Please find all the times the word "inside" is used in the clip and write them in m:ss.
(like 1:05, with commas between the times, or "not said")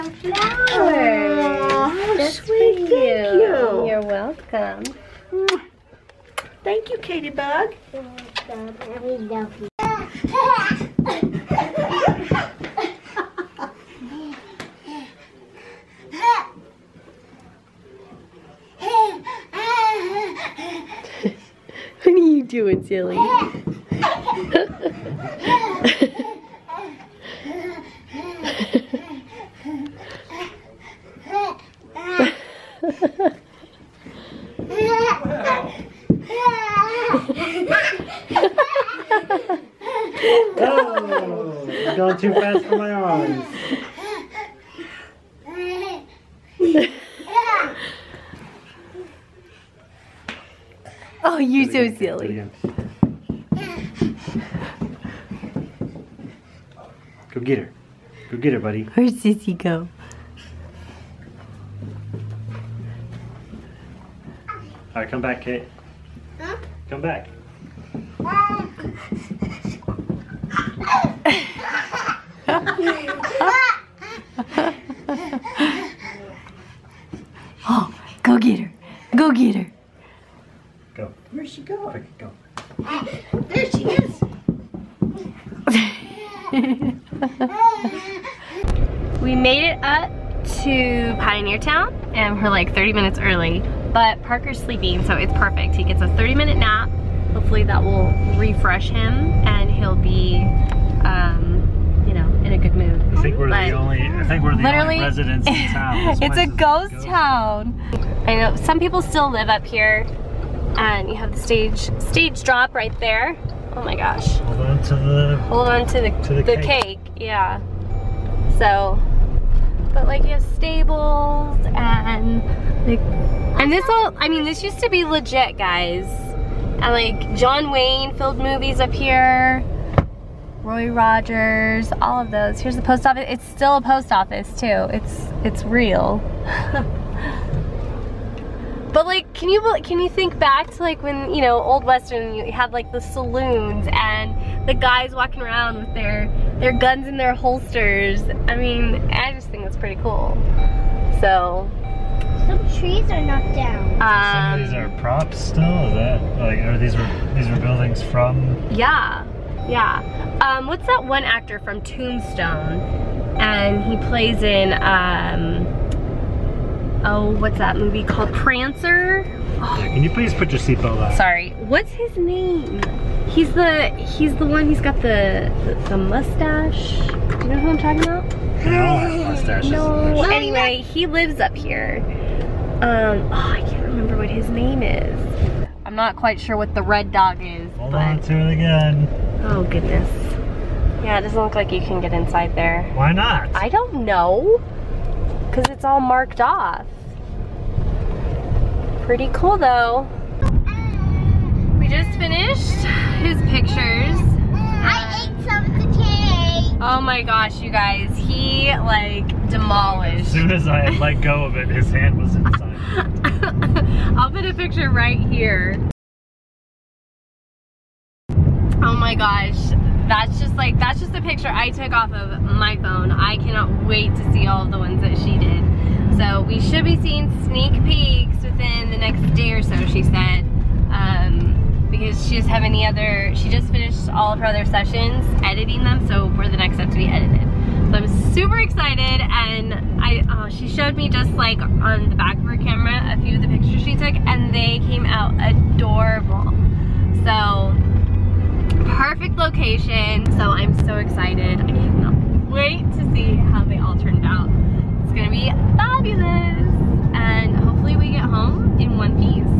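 3:12, 3:32.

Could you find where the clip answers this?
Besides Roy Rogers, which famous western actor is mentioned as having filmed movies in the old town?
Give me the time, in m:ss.
2:07.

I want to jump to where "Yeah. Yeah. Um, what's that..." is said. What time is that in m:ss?
2:38.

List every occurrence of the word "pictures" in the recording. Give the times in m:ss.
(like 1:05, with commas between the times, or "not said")
3:23, 3:34, 3:41, 4:03.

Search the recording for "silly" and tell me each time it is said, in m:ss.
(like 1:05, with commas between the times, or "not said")
0:22, 0:51.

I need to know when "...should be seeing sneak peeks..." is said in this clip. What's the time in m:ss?
3:46.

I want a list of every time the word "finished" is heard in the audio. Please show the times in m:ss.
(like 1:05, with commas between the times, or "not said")
3:22, 3:53.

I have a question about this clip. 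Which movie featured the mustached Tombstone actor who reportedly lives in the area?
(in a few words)
Prancer.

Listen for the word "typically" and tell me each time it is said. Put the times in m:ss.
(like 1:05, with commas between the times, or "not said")
not said.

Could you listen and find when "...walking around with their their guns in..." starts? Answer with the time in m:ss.
2:25.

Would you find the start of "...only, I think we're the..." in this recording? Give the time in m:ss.
1:43.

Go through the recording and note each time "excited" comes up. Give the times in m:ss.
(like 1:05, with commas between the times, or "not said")
3:58, 4:10.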